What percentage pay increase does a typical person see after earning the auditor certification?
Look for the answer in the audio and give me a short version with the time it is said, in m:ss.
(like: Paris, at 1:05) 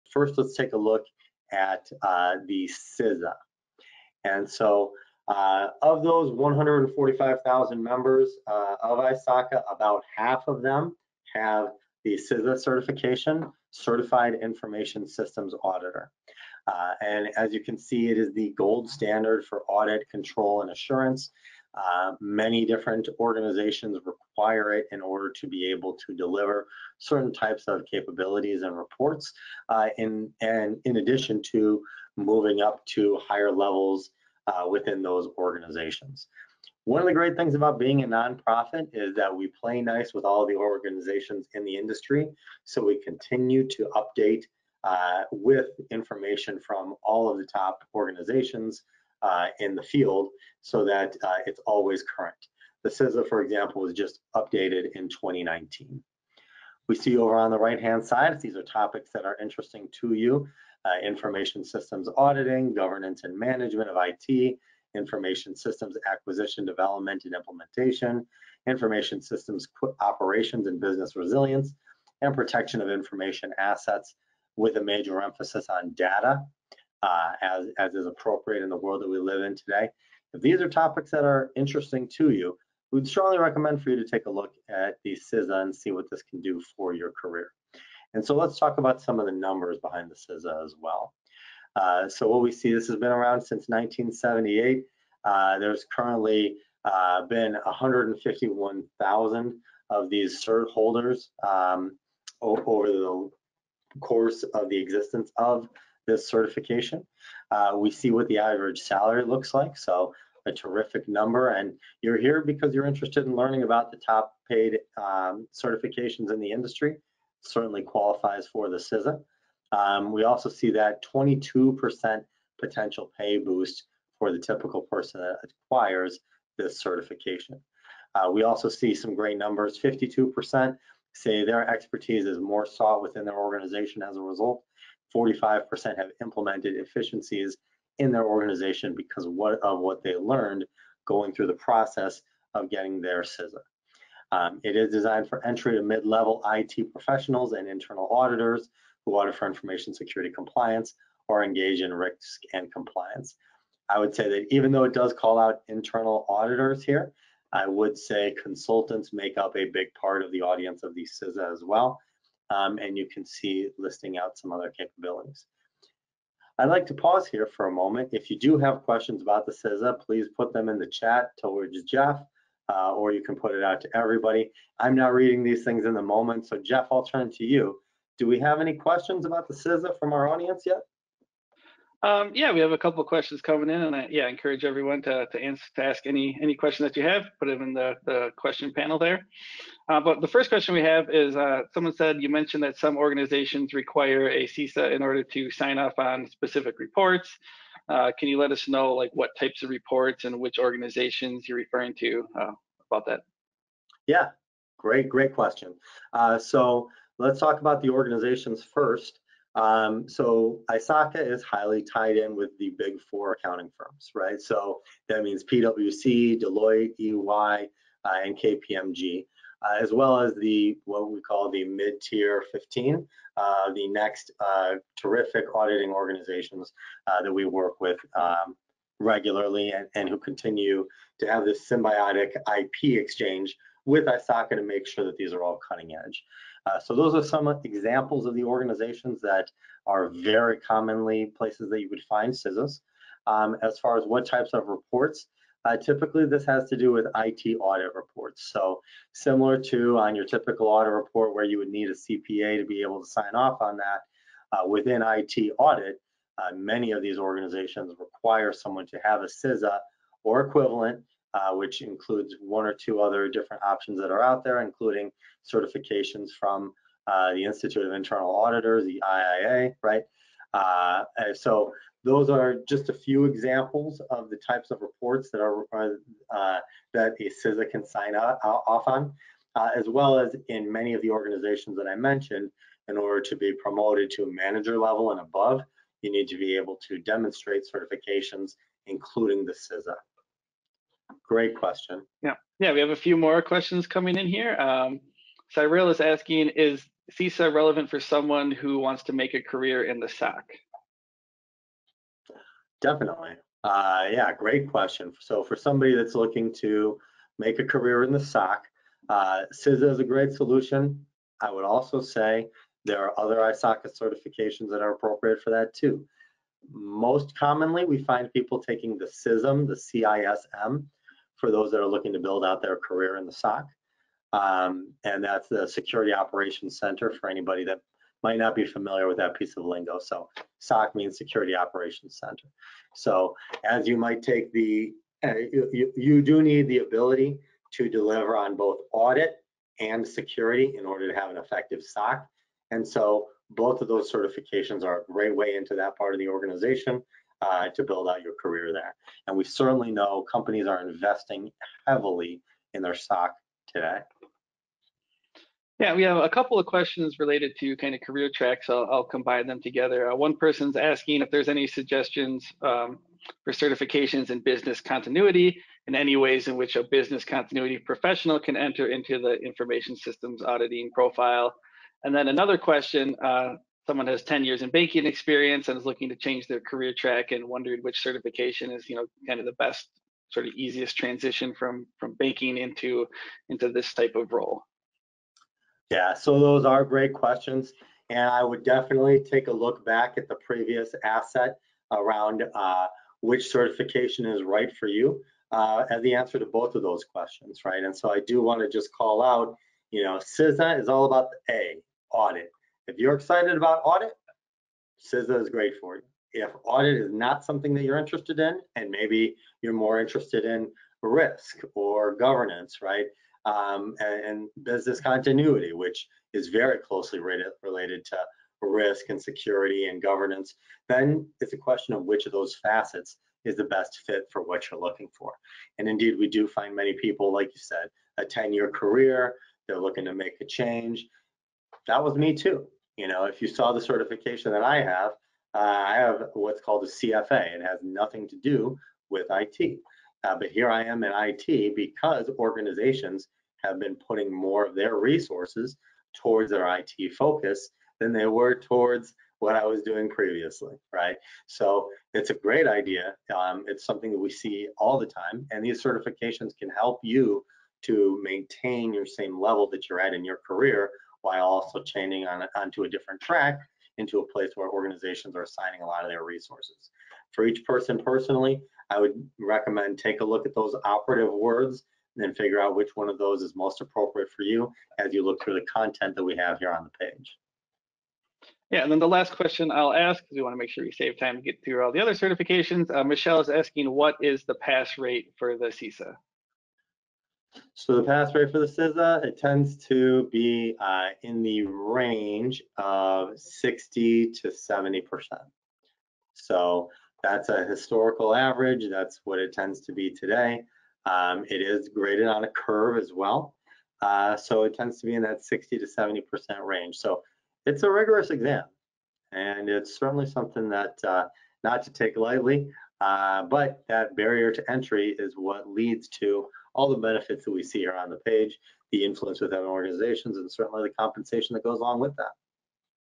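22%, at 2:01.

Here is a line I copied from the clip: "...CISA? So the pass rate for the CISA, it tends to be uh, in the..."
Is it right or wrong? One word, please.
right.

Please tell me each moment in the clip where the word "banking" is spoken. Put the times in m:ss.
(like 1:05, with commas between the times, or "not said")
6:14, 6:22.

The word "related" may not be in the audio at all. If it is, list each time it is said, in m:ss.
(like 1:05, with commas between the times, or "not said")
5:57, 6:57.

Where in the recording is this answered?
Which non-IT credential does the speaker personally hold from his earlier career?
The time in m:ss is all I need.
7:16.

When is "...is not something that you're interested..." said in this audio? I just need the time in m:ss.
6:47.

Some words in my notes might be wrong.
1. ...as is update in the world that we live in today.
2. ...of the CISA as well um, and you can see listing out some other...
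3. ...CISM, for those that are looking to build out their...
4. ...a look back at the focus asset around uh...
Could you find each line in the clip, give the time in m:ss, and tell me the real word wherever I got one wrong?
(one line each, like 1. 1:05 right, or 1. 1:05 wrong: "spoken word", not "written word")
1. 1:17 wrong: "appropriate", not "update"
2. 2:40 right
3. 5:19 right
4. 6:29 wrong: "previous", not "focus".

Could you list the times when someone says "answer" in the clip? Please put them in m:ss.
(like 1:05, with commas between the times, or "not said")
3:05, 6:36.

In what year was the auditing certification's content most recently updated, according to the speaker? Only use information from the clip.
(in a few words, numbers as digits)
2019.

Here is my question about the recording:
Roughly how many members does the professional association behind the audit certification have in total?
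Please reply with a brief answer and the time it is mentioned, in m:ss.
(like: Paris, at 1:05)
145,000, at 0:06.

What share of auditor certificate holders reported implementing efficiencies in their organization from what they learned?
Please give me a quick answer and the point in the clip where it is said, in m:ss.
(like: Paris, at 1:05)
45%, at 2:15.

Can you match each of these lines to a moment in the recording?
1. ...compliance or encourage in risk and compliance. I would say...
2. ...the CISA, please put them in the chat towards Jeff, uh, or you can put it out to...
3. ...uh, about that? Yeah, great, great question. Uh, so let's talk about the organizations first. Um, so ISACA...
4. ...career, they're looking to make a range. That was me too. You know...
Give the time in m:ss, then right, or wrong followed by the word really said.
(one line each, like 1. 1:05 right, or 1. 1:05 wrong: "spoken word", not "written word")
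1. 2:30 wrong: "engage", not "encourage"
2. 2:49 right
3. 3:22 right
4. 7:08 wrong: "change", not "range".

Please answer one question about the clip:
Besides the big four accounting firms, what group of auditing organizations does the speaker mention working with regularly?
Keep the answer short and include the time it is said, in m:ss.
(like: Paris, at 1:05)
mid-tier 15, at 3:41.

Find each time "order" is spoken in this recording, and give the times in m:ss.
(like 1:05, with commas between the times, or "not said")
0:25, 3:15, 4:42, 5:40.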